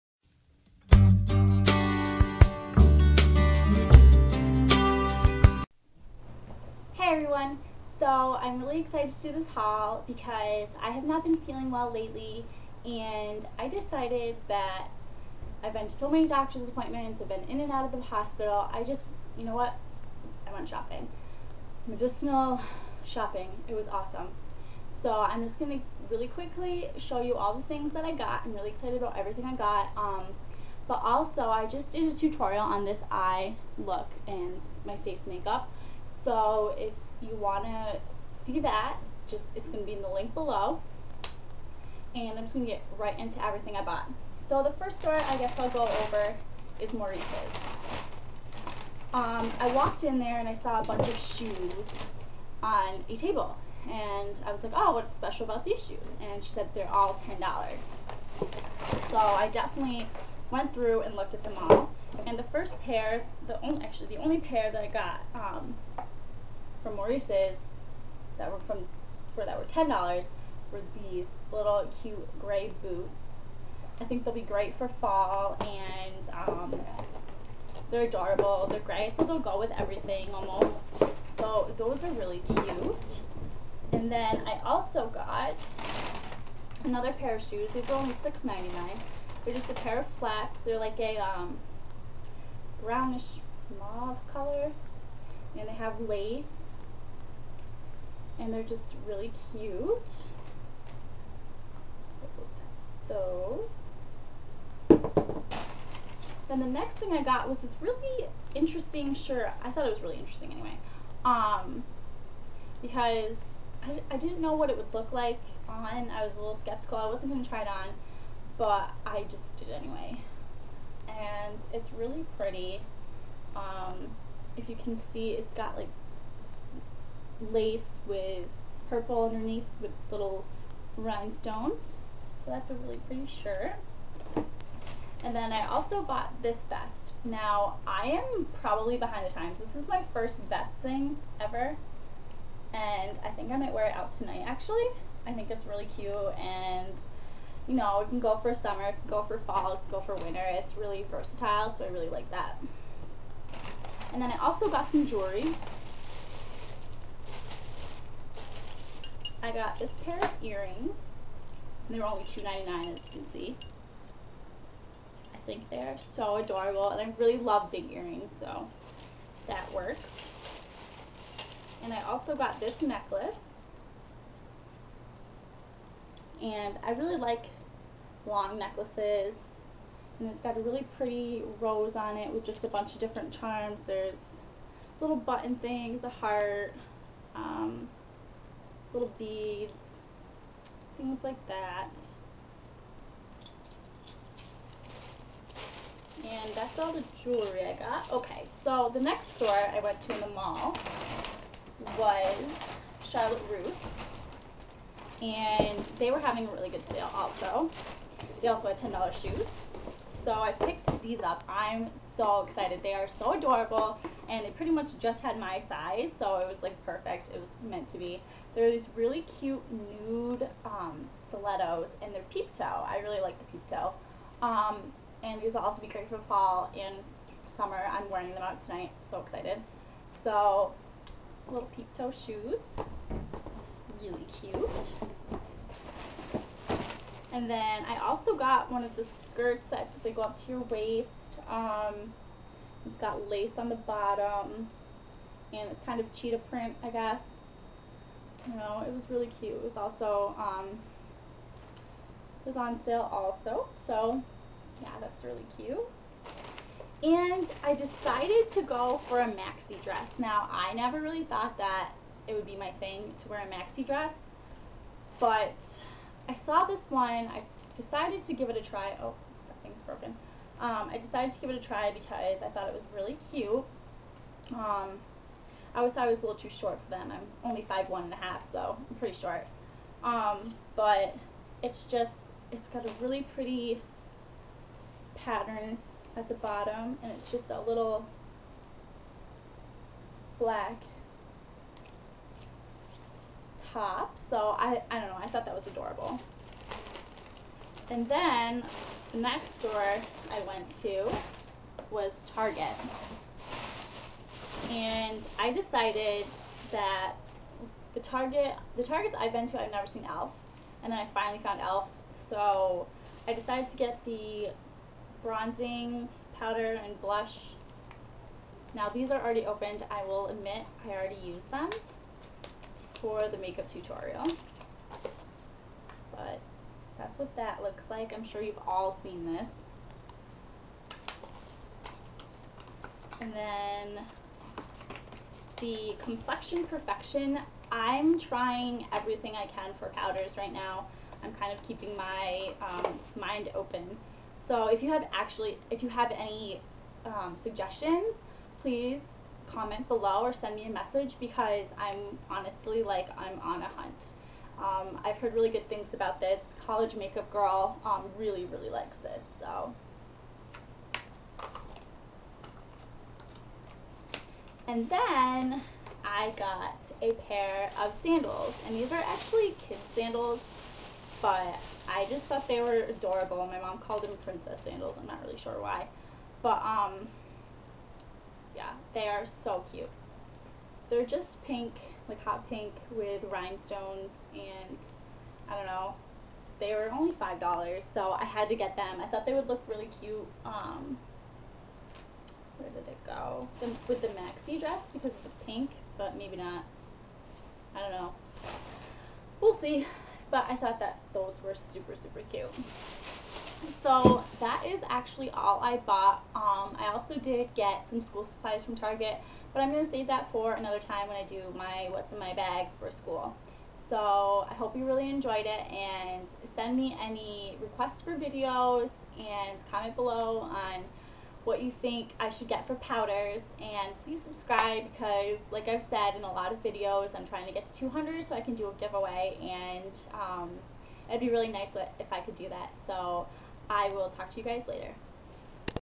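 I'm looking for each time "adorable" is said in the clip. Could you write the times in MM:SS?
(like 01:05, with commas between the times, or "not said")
01:18, 02:46, 03:33, 04:55, 06:12.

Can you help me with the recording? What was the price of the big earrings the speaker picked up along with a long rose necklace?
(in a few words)
$2.99.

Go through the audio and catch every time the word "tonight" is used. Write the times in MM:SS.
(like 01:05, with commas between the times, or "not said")
02:24, 03:48.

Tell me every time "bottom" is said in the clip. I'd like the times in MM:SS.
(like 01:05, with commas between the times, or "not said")
04:03, 04:46.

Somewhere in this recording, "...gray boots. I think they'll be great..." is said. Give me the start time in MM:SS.
01:12.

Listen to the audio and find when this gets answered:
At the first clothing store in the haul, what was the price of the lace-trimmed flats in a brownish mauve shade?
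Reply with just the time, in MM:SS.
01:28.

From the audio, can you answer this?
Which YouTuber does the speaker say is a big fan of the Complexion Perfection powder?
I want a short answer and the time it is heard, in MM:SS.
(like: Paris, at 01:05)
College Makeup Girl, at 05:56.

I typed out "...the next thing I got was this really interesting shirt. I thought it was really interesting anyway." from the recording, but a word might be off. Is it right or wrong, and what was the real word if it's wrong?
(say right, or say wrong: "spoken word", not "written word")
right.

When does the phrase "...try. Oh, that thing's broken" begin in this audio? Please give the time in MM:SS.
04:28.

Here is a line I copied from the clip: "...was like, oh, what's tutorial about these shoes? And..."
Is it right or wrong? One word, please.
wrong.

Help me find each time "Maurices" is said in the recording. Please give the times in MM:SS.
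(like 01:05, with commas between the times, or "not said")
00:46, 01:06.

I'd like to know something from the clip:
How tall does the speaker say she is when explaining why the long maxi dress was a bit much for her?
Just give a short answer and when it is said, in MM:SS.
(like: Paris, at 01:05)
5'1.5", at 04:37.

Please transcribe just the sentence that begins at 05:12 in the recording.
So I decided to get the bronzing powder and blush.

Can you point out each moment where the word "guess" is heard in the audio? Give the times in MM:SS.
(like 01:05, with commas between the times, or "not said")
00:45, 04:06.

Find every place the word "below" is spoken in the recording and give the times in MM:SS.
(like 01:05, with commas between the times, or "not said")
00:40, 05:49, 06:59.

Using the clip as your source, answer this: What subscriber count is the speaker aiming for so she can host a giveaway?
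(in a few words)
200.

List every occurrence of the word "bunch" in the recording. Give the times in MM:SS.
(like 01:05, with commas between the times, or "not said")
00:50, 03:02.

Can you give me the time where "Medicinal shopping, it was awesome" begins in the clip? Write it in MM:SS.
00:21.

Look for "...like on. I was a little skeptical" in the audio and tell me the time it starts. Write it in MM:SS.
01:55.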